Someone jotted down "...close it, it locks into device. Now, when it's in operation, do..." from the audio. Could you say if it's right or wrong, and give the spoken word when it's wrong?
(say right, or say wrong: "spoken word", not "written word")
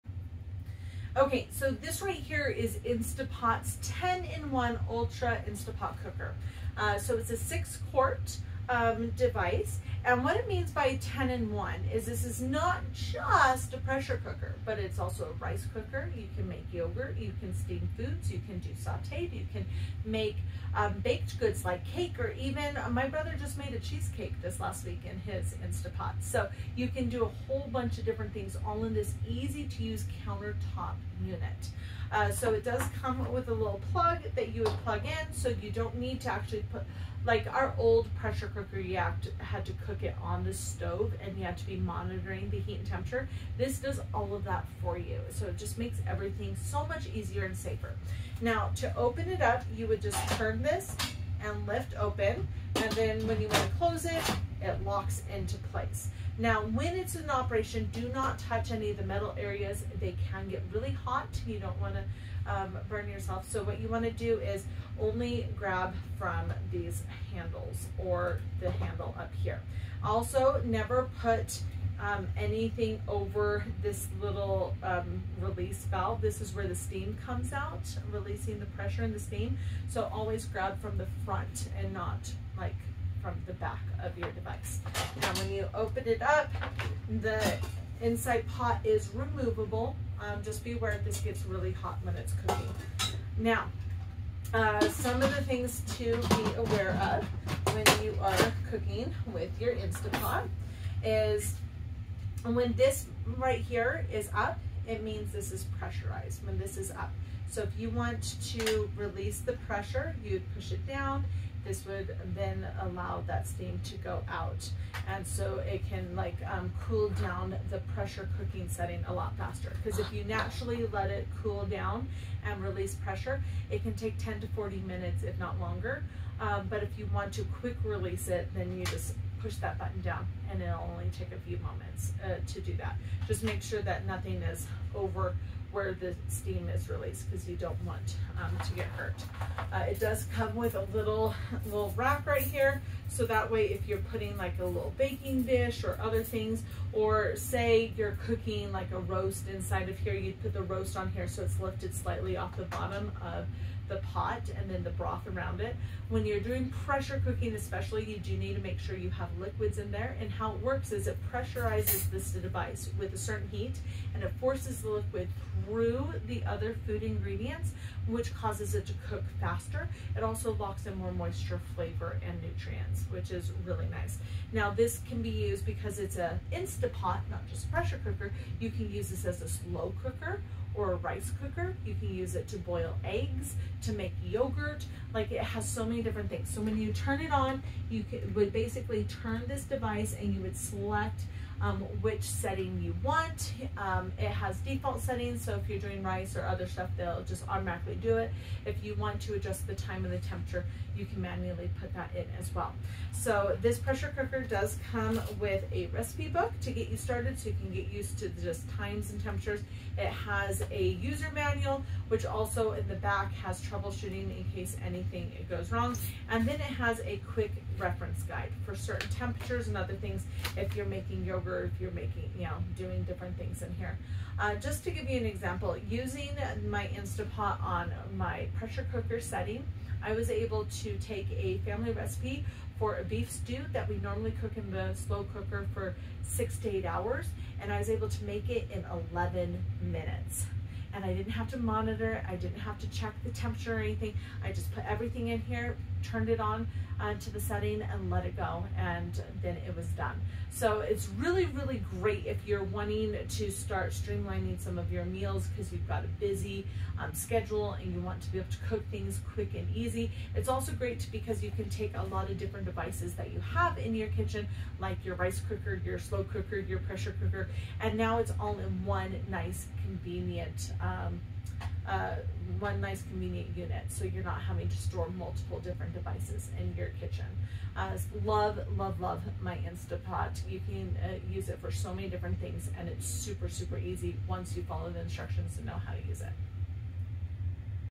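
wrong: "place", not "device".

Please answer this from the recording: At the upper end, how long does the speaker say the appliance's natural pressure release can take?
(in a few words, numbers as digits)
40 minutes.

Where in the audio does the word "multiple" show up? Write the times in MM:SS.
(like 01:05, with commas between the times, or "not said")
04:35.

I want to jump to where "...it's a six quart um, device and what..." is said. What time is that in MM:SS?
00:07.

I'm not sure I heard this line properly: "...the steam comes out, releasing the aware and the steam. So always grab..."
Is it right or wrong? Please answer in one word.
wrong.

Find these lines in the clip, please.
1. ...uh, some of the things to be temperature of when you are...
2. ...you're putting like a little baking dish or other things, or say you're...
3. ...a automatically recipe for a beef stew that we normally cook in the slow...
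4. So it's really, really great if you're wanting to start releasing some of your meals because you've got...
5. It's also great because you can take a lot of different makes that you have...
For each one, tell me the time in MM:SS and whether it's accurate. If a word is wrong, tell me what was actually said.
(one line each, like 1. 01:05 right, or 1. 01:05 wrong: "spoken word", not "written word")
1. 01:34 wrong: "aware", not "temperature"
2. 02:23 right
3. 03:51 wrong: "family", not "automatically"
4. 04:10 wrong: "streamlining", not "releasing"
5. 04:20 wrong: "devices", not "makes".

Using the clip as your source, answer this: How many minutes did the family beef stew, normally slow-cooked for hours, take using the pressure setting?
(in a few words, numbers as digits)
11 minutes.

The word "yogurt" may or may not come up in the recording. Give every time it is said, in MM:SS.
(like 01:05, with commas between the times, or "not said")
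00:16, 03:04, 03:41.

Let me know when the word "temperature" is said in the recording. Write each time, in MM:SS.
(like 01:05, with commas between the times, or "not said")
00:42, 03:20, 03:29, 03:39, 04:03.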